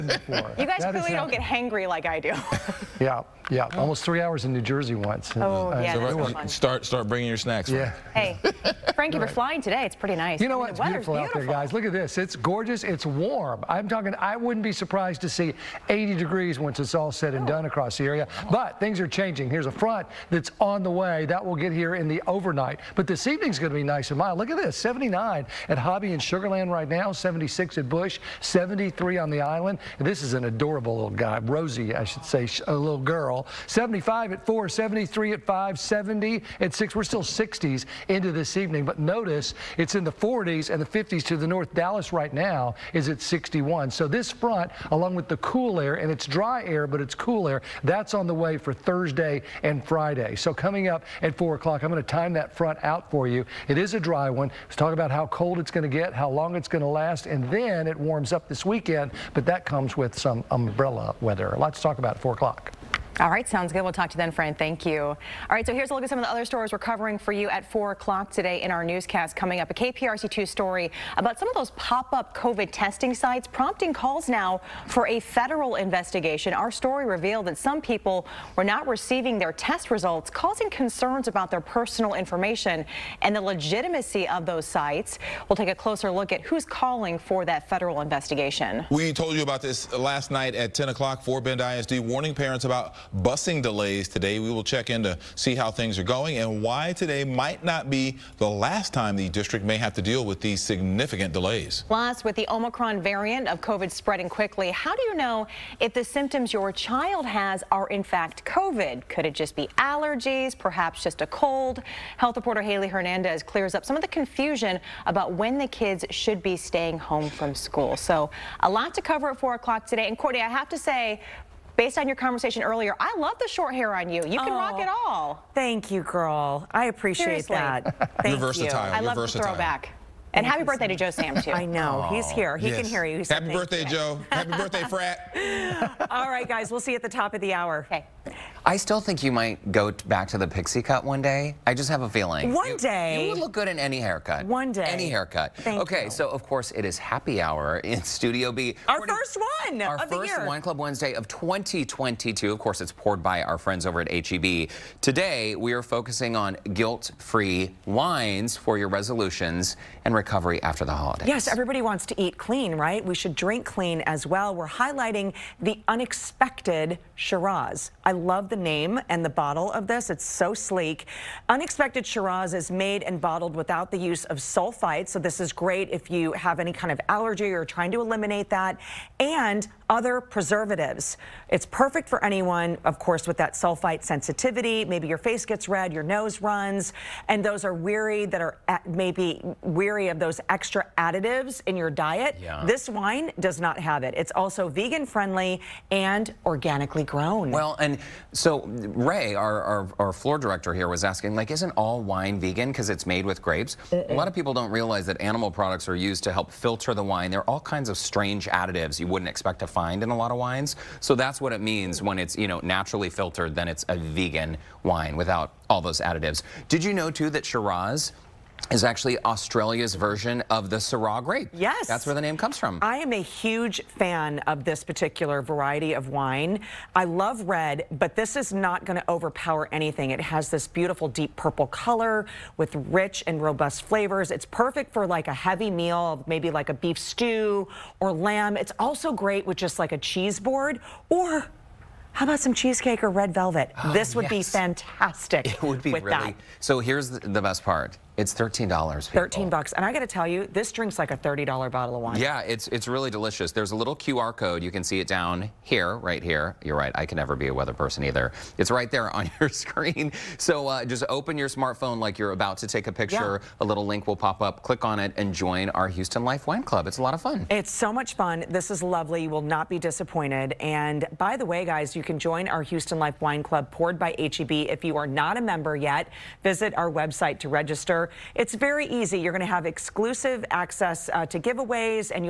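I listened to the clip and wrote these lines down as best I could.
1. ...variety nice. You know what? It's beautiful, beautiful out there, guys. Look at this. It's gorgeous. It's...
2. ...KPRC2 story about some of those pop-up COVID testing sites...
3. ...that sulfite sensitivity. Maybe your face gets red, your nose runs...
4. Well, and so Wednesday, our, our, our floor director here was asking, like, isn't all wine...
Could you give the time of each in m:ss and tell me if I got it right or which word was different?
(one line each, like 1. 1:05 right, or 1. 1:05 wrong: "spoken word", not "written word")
1. 0:09 wrong: "pretty", not "variety"
2. 1:09 right
3. 3:03 right
4. 3:17 wrong: "Ray", not "Wednesday".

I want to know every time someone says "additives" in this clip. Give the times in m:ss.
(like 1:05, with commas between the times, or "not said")
3:10, 3:28, 3:35.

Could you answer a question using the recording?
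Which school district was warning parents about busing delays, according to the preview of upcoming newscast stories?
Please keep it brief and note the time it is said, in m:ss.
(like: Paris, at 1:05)
Fort Bend ISD, at 1:31.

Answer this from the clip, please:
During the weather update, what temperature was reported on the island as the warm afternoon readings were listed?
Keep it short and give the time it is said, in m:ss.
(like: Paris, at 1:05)
73, at 0:28.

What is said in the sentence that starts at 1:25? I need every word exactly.
We'll take a closer look at who's calling for that federal investigation.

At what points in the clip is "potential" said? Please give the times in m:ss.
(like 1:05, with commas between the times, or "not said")
not said.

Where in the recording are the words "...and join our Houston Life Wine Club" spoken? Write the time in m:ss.
4:25.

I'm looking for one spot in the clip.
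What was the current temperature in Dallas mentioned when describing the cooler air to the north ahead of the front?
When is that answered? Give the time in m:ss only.
0:43.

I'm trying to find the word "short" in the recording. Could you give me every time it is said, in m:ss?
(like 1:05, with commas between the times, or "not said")
2:03.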